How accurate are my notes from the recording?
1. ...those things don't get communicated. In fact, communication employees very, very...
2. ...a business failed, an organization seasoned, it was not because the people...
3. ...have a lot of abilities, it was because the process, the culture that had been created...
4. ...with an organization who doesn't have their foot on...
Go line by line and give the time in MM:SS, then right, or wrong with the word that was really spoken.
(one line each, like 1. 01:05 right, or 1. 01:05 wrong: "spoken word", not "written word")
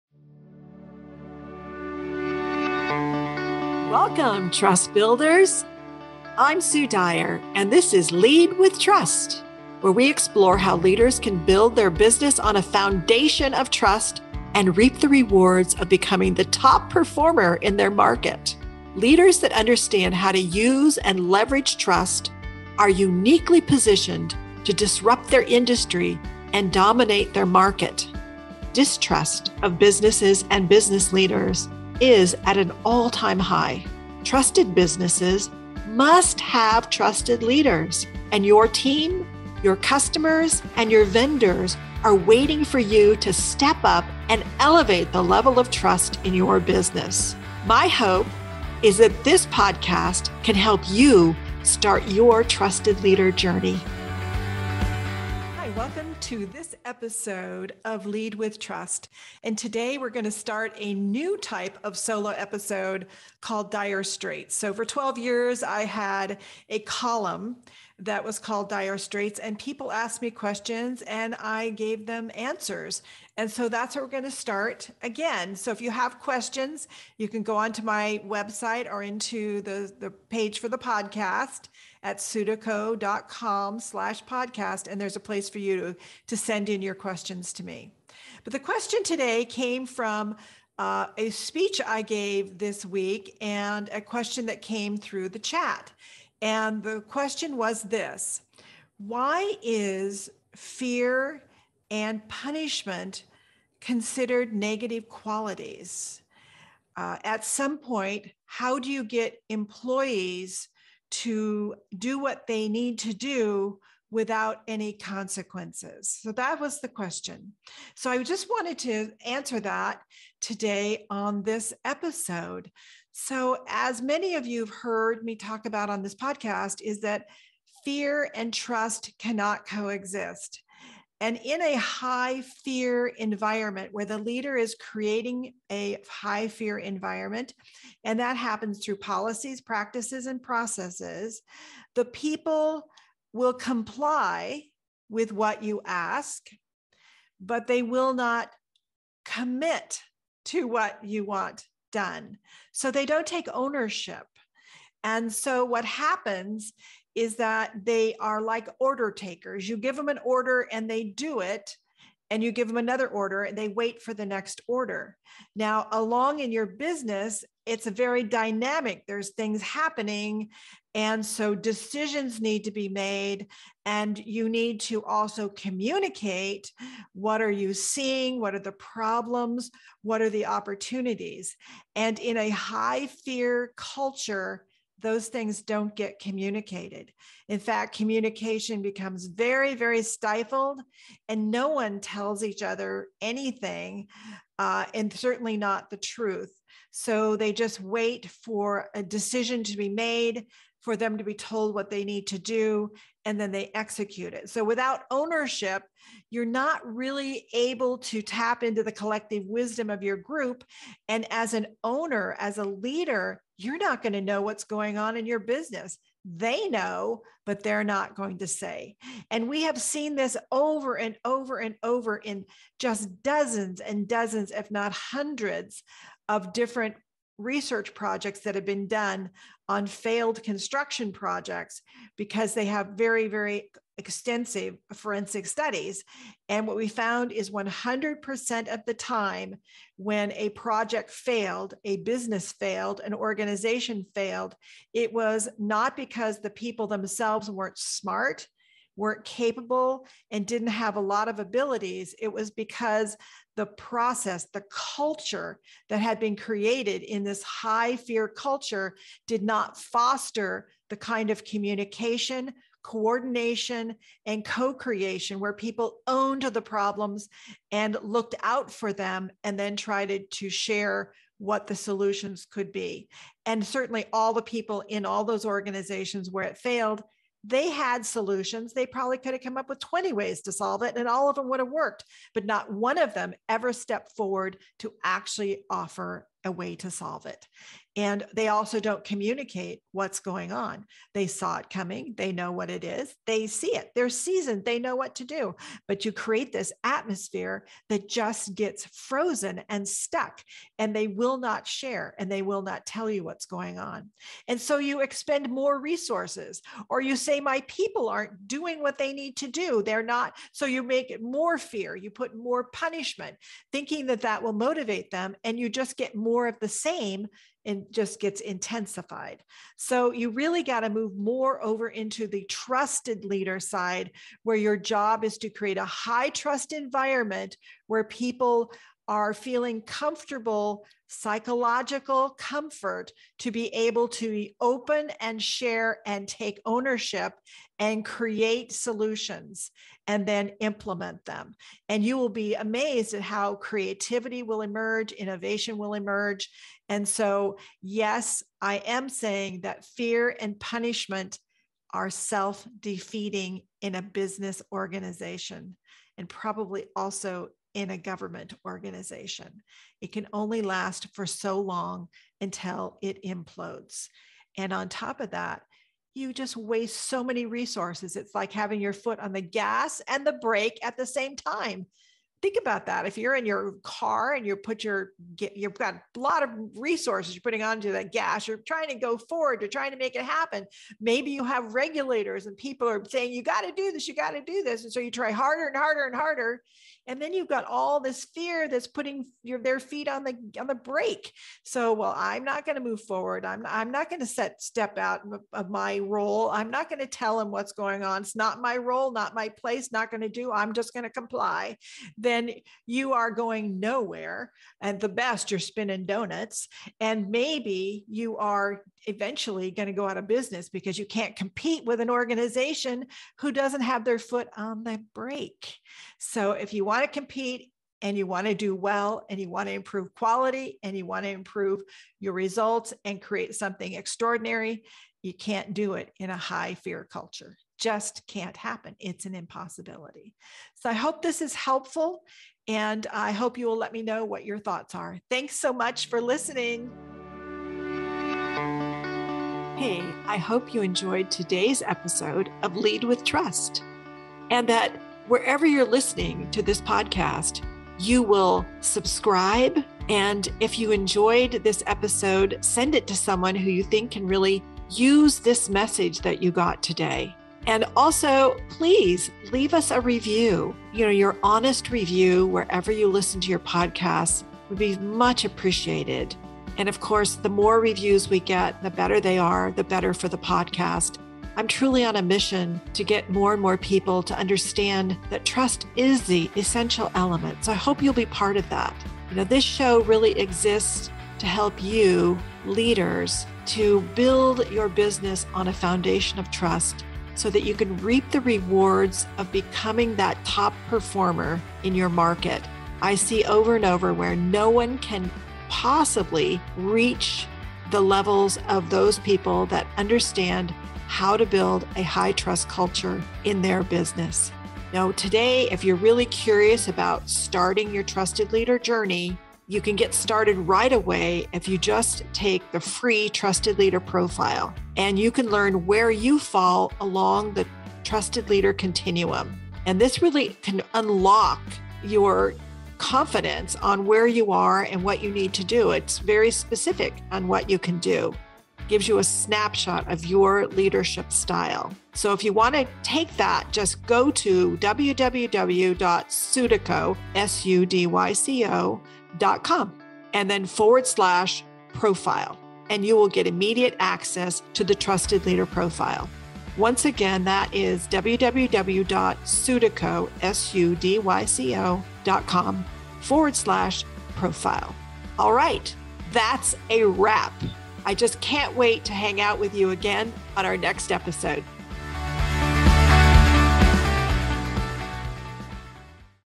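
1. 03:05 wrong: "becomes", not "employees"
2. 04:01 wrong: "failed", not "seasoned"
3. 04:10 right
4. 06:51 right.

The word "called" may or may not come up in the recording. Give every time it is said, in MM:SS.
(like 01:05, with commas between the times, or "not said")
01:03, 01:08.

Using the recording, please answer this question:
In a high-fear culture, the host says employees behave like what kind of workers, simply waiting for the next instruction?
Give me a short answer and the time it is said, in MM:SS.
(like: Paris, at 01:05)
Order takers, at 02:38.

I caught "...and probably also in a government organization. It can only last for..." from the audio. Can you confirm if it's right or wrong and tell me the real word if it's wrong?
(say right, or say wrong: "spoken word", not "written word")
right.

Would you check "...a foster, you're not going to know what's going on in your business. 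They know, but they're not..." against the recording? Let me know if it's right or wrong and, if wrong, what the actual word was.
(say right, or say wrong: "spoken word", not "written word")
wrong: "leader", not "foster".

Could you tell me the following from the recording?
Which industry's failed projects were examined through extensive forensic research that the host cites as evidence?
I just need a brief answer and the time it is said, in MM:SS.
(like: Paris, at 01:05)
Construction, at 03:50.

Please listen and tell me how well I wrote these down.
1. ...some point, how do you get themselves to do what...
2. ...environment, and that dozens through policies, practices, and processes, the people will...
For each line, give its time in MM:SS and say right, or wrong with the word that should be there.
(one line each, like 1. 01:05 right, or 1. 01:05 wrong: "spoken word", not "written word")
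1. 01:47 wrong: "employees", not "themselves"
2. 02:16 wrong: "happens", not "dozens".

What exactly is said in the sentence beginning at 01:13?
And so that's where we're going to start again.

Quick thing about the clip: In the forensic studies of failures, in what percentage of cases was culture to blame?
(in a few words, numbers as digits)
100%.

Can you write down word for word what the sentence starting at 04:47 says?
And they also don't communicate what's going on.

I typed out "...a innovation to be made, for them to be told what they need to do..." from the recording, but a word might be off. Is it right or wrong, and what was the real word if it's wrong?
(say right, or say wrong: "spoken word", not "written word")
wrong: "decision", not "innovation".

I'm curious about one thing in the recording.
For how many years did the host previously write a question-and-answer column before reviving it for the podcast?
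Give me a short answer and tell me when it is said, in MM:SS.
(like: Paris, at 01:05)
12, at 01:04.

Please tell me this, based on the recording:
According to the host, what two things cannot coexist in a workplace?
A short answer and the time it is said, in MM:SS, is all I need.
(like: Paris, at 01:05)
Fear and trust, at 02:07.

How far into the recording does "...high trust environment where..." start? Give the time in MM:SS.
05:25.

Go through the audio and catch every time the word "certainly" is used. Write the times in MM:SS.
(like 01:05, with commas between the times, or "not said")
03:15, 04:33.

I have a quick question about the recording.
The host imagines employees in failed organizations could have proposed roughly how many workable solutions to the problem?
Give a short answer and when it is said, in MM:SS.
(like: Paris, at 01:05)
20, at 04:39.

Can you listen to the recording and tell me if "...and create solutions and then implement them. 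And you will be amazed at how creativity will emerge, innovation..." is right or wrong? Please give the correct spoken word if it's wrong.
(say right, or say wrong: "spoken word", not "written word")
right.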